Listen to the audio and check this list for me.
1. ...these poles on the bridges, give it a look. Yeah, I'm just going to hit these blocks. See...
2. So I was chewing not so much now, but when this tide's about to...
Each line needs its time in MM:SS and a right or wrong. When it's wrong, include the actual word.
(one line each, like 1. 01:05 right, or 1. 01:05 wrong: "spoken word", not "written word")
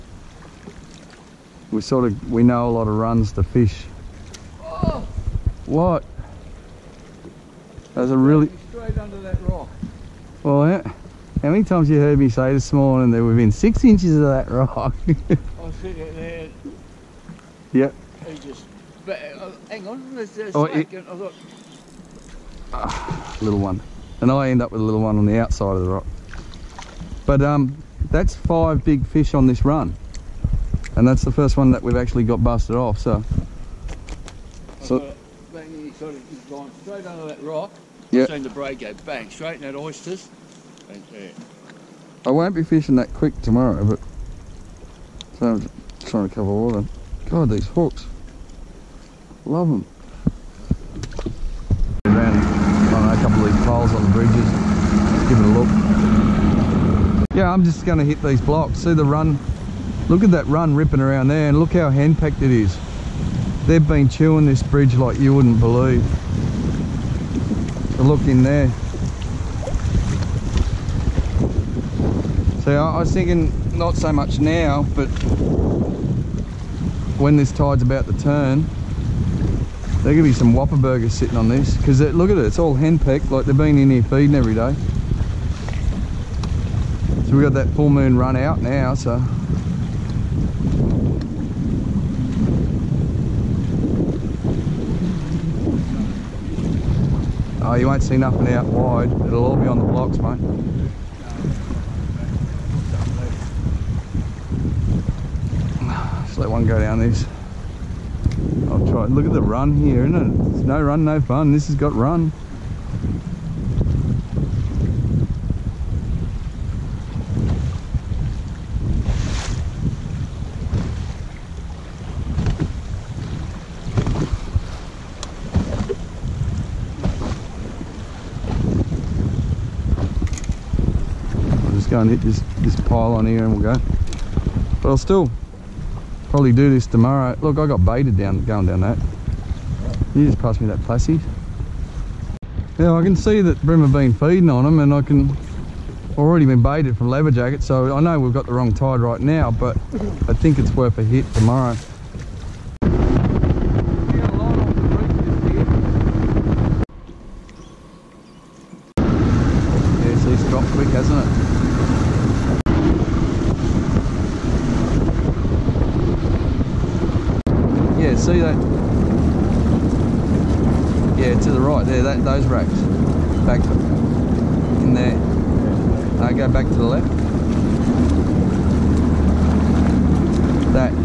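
1. 00:53 right
2. 01:12 wrong: "thinking", not "chewing".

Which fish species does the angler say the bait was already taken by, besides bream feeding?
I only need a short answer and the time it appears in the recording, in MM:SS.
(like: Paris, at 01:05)
leather jacket, at 02:27.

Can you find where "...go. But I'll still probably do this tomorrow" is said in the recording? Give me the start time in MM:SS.
02:13.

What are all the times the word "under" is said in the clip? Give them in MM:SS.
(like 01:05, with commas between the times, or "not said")
00:08, 00:37.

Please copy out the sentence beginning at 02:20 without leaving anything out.
You just passed me that plassey.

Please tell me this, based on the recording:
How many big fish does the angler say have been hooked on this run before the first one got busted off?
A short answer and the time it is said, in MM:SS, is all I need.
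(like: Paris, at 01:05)
5, at 00:28.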